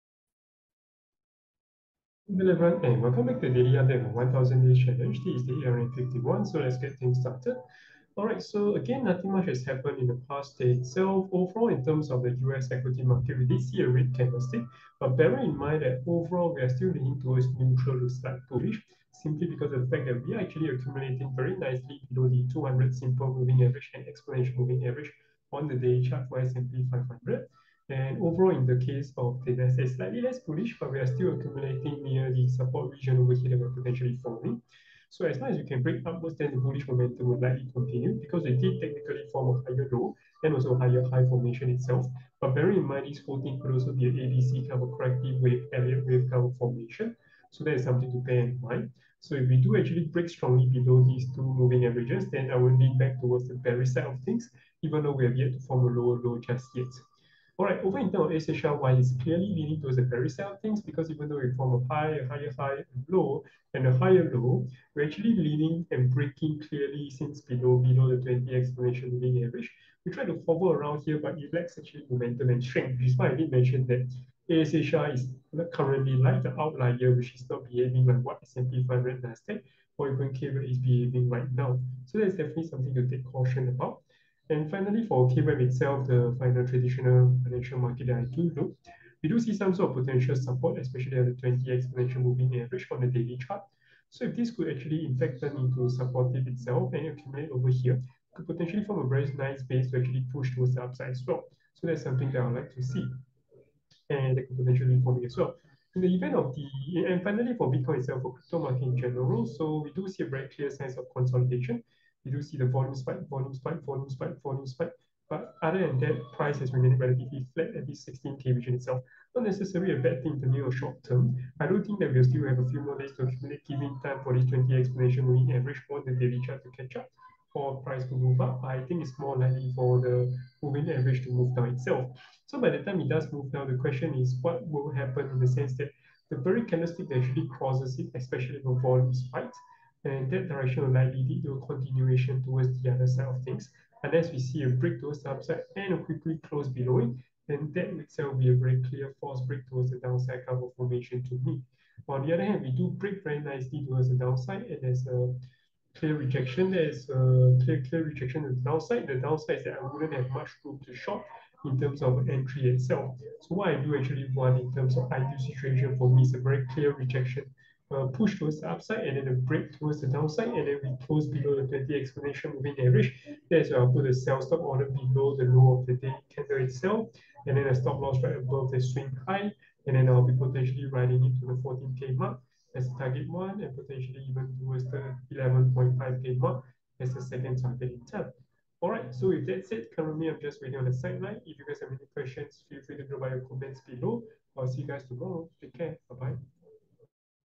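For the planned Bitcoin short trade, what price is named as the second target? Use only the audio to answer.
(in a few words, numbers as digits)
11.5K.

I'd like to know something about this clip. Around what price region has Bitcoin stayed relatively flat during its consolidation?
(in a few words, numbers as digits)
16K.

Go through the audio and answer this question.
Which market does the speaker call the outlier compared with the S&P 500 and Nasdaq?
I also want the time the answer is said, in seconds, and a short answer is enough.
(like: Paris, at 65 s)
ASHR, at 74 s.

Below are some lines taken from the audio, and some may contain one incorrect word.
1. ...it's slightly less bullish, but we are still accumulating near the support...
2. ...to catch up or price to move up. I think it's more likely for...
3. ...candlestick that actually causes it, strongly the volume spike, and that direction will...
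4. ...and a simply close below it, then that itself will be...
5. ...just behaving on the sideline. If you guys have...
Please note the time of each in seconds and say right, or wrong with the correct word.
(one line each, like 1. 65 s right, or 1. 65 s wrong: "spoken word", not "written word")
1. 29 s right
2. 126 s right
3. 136 s wrong: "especially", not "strongly"
4. 145 s wrong: "quickly", not "simply"
5. 190 s wrong: "waiting", not "behaving".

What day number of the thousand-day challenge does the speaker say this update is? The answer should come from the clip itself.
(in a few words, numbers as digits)
51.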